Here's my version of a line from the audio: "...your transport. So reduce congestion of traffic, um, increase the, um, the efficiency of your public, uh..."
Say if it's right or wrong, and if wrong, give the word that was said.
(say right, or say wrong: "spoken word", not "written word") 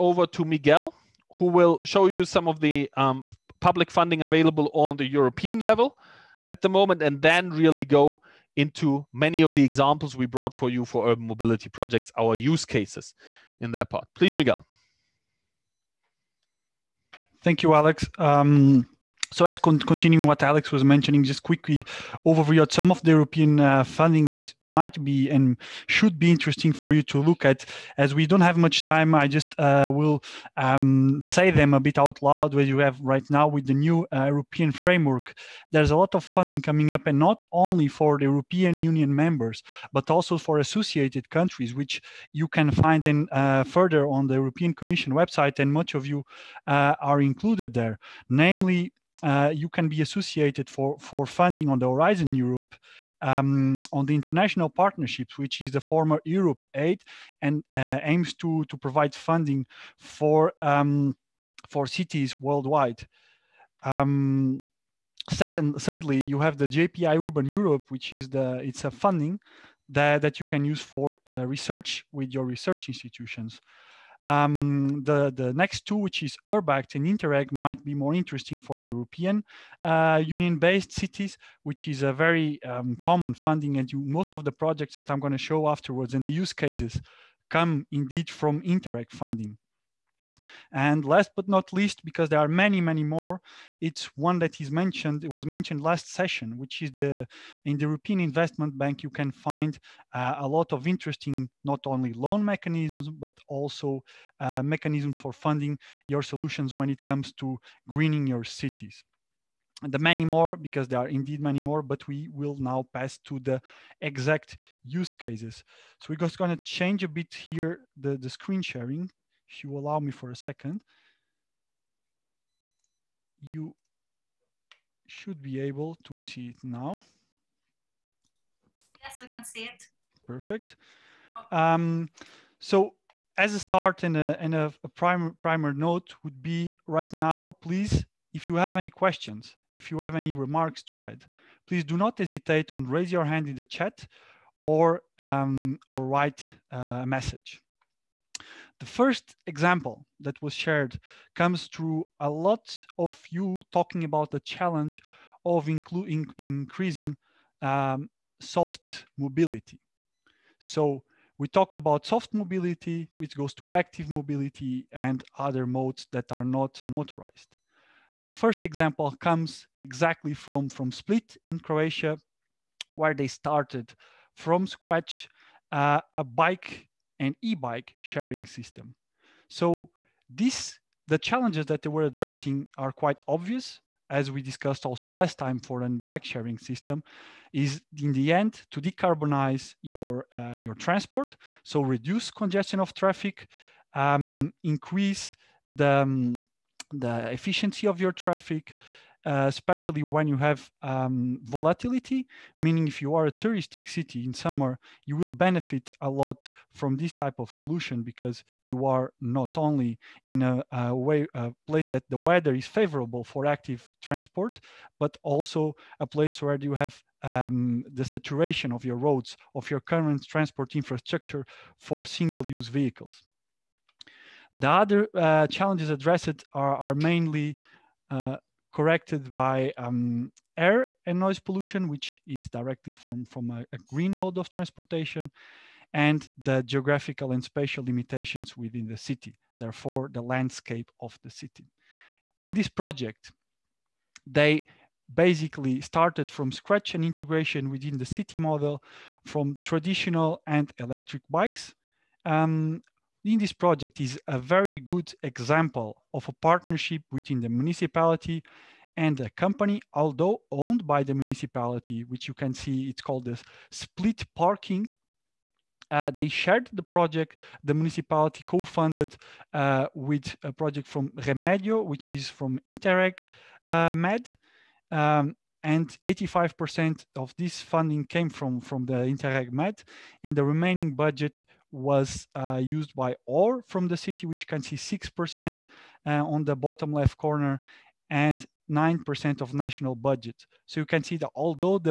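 wrong: "traffic", not "public".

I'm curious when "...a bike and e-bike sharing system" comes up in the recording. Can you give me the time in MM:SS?
02:56.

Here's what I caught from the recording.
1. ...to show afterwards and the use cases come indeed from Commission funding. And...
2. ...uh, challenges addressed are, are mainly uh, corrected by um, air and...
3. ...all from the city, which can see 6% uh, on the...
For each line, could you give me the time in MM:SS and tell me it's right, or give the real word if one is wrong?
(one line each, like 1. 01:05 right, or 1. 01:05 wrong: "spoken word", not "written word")
1. 01:25 wrong: "Interreg", not "Commission"
2. 03:45 right
3. 04:43 right.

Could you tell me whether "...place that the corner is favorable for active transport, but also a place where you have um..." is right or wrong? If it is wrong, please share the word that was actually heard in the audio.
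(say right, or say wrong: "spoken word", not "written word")
wrong: "weather", not "corner".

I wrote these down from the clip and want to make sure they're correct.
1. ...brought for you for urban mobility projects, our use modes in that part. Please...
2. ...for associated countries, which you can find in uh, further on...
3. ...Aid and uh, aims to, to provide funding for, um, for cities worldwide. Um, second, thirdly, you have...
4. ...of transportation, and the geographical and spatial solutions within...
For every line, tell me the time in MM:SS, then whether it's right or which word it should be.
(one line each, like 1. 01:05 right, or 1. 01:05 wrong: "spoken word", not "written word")
1. 00:10 wrong: "cases", not "modes"
2. 00:40 right
3. 00:56 right
4. 03:54 wrong: "limitations", not "solutions".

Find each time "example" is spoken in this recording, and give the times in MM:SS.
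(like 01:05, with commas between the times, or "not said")
00:09, 02:29, 02:48, 04:15.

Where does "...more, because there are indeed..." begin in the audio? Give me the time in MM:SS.
01:50.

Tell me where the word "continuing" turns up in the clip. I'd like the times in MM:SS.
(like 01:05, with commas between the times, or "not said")
00:19.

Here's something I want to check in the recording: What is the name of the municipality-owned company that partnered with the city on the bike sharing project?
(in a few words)
Split Parking.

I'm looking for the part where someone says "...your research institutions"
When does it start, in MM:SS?
01:12.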